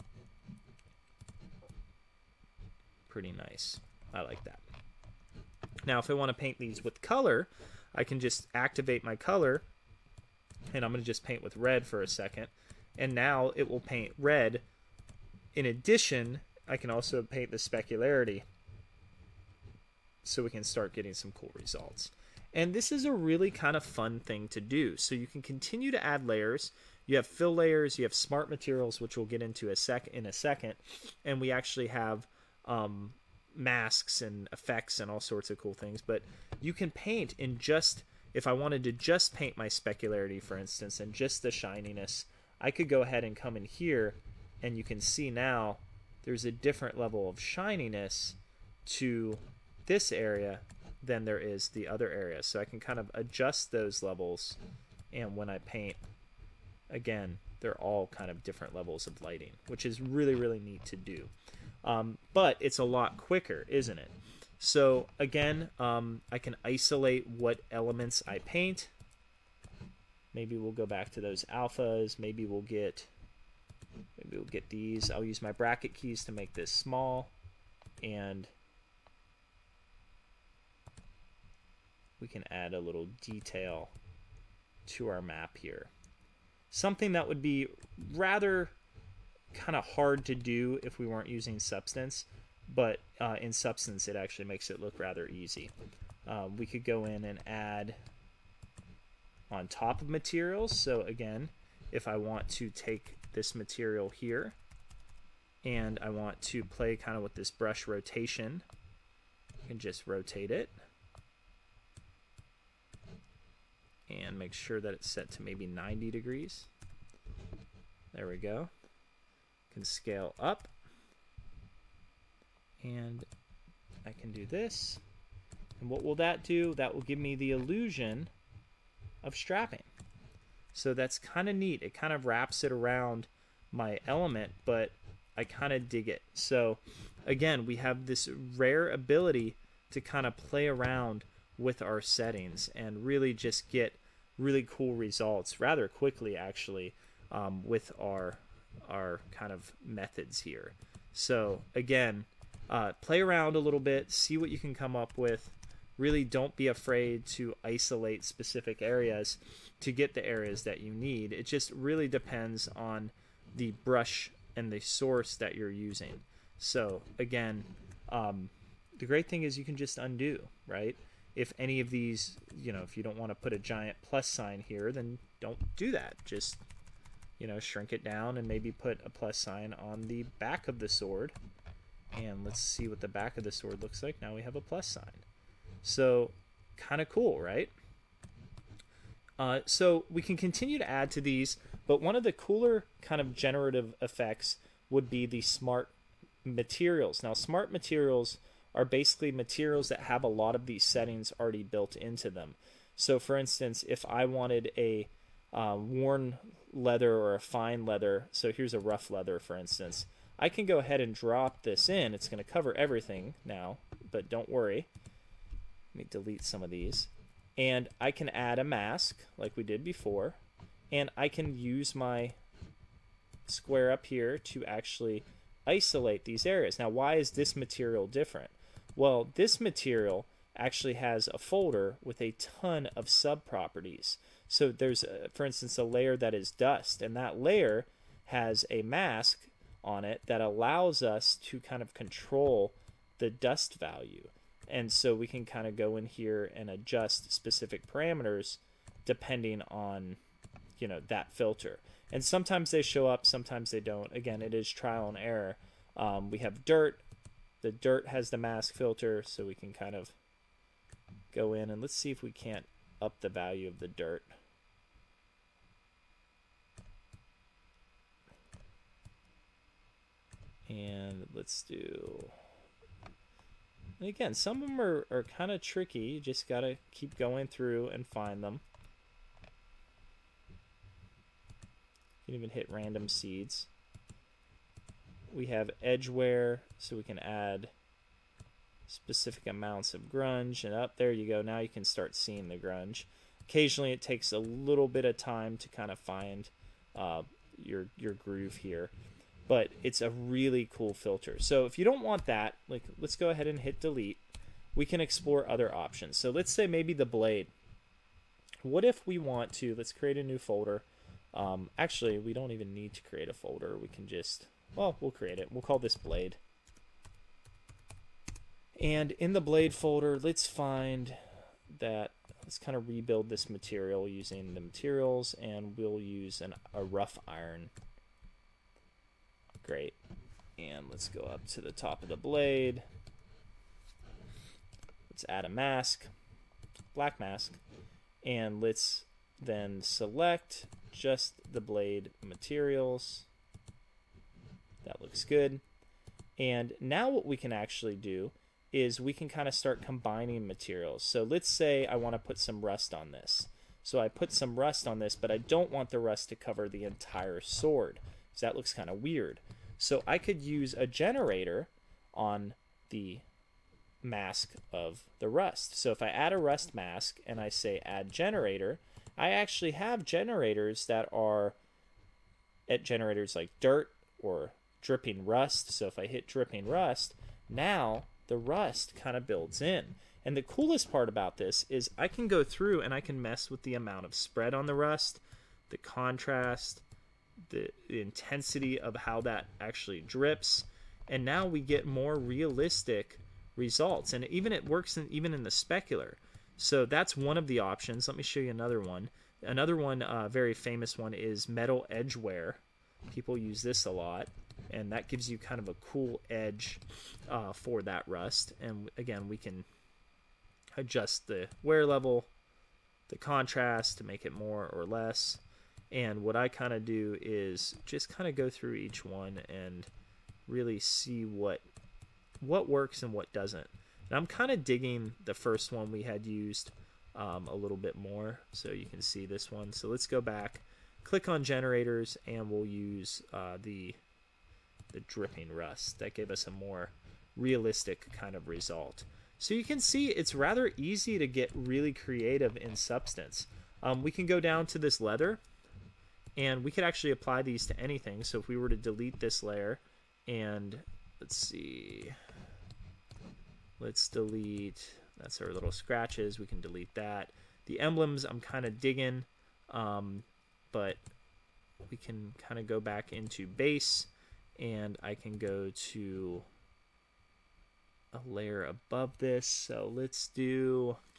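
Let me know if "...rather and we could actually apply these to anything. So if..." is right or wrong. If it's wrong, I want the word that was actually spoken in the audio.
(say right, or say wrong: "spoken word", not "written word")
wrong: "leather", not "rather".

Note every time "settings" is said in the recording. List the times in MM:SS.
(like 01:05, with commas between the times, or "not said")
02:22, 03:20.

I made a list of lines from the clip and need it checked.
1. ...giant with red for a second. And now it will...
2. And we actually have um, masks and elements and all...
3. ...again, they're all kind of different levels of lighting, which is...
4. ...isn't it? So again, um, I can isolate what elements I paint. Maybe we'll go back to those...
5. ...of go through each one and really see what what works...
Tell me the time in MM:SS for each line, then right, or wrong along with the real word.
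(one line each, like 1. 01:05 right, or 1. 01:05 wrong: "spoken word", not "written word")
1. 00:11 wrong: "paint", not "giant"
2. 00:31 wrong: "effects", not "elements"
3. 00:56 right
4. 01:03 right
5. 06:58 right.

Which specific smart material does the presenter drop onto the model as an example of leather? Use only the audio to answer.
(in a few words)
rough leather.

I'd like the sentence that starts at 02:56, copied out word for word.
Just, you know, shrink it down and maybe put a plus sign on the back of the sword.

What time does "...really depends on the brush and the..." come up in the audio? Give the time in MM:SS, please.
02:41.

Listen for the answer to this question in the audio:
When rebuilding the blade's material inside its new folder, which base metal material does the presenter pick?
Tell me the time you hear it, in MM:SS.
05:26.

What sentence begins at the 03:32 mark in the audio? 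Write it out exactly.
It's going to cover everything now, but don't worry.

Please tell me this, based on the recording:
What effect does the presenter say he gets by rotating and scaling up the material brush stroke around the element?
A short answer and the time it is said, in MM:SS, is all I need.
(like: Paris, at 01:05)
strapping, at 02:09.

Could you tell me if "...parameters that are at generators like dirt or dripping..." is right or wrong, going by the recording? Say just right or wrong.
wrong.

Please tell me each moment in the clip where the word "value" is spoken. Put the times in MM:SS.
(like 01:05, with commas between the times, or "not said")
04:03, 04:23.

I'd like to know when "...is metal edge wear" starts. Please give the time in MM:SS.
06:41.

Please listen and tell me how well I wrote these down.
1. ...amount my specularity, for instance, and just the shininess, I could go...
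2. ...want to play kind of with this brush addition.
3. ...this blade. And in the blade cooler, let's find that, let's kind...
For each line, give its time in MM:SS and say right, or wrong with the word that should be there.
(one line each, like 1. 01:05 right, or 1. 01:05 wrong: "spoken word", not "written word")
1. 00:39 wrong: "paint", not "amount"
2. 01:46 wrong: "rotation", not "addition"
3. 05:15 wrong: "folder", not "cooler".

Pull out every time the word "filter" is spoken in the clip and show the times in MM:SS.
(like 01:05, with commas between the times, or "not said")
04:11, 04:18, 05:00.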